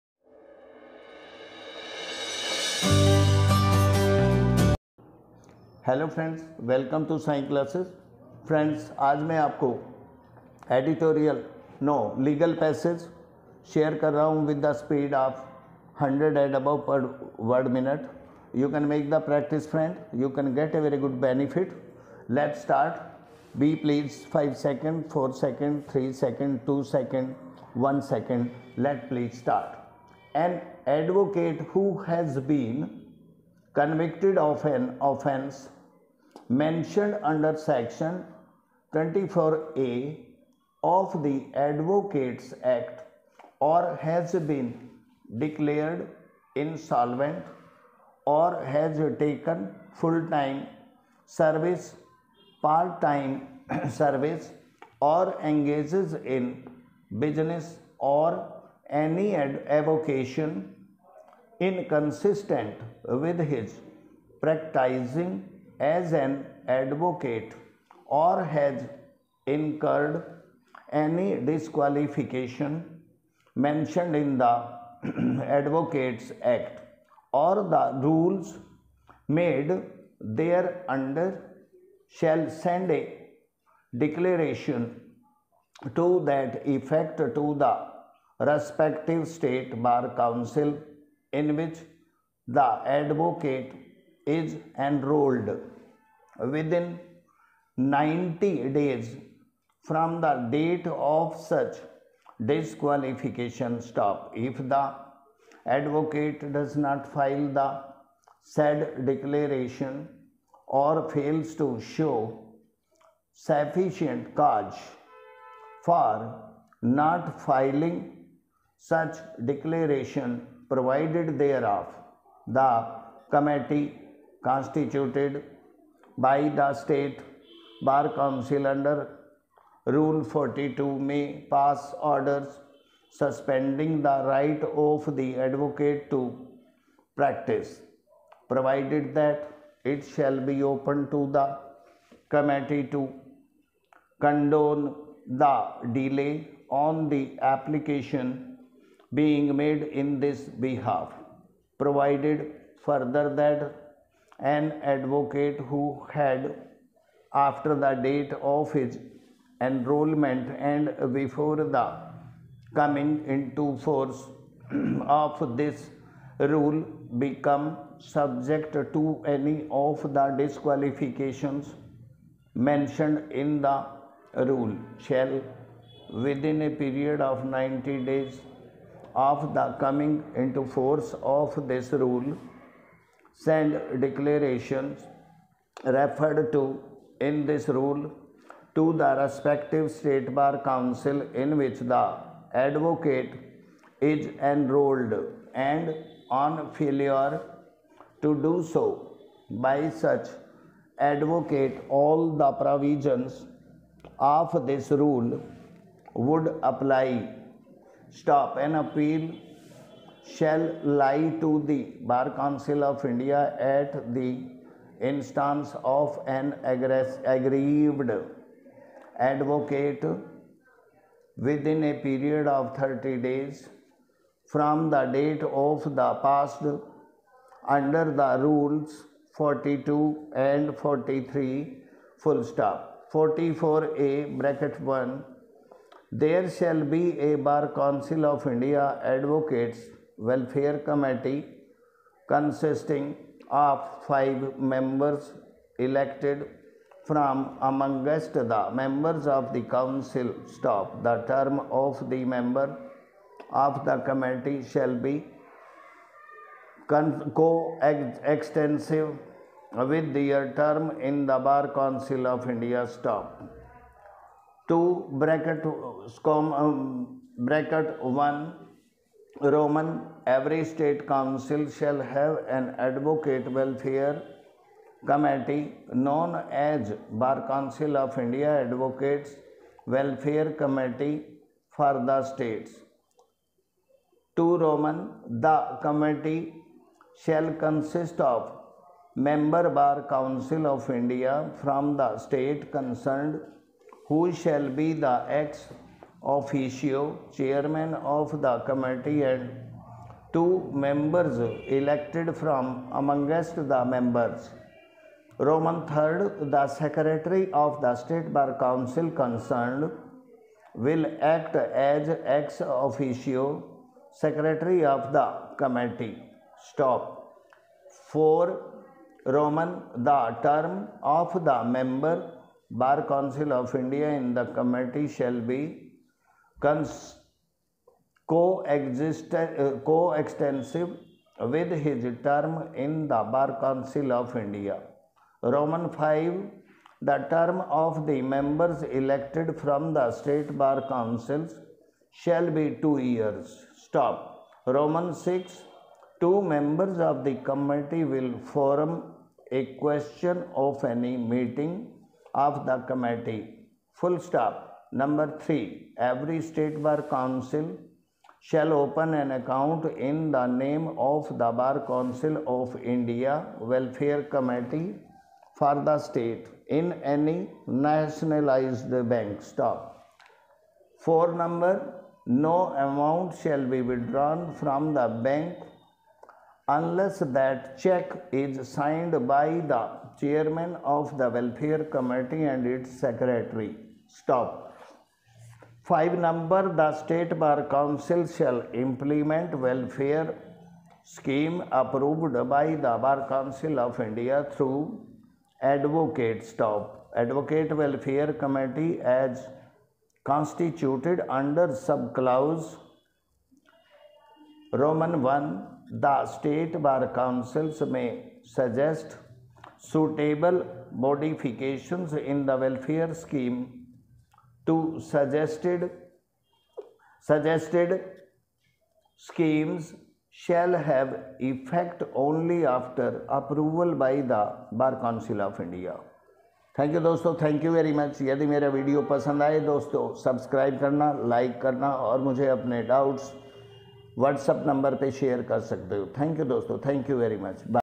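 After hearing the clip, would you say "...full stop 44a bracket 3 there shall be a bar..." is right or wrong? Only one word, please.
wrong.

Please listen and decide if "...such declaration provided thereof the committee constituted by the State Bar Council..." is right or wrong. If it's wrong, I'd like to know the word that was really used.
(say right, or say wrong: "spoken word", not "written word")
right.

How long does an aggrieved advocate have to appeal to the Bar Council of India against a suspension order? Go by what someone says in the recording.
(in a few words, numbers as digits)
30 days.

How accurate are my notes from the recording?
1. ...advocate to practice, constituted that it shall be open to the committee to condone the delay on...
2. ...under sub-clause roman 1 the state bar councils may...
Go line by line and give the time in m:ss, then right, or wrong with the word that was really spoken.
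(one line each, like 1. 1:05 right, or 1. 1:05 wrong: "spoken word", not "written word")
1. 2:15 wrong: "provided", not "constituted"
2. 6:41 right.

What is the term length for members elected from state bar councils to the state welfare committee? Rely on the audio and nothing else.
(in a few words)
Two years.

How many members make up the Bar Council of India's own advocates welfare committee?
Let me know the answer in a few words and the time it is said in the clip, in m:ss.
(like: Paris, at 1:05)
Five, at 4:04.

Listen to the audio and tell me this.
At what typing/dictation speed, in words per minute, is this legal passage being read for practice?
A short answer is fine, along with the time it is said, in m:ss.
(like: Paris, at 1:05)
100 and above, at 0:16.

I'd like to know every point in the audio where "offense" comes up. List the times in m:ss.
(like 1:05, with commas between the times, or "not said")
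0:35.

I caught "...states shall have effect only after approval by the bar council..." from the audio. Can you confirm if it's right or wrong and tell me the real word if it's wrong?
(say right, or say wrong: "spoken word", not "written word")
wrong: "schemes", not "states".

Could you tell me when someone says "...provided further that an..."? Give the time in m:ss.
2:31.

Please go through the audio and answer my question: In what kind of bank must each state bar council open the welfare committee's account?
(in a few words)
Nationalized bank.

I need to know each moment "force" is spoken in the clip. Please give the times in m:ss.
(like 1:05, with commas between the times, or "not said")
2:43, 3:00.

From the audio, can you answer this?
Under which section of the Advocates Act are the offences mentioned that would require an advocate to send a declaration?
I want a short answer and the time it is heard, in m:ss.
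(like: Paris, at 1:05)
Section 24A, at 0:37.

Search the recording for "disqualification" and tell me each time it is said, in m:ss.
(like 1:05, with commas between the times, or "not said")
1:11, 1:42, 2:50.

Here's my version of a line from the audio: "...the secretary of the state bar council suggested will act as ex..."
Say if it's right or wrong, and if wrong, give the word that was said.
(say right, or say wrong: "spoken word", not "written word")
wrong: "concerned", not "suggested".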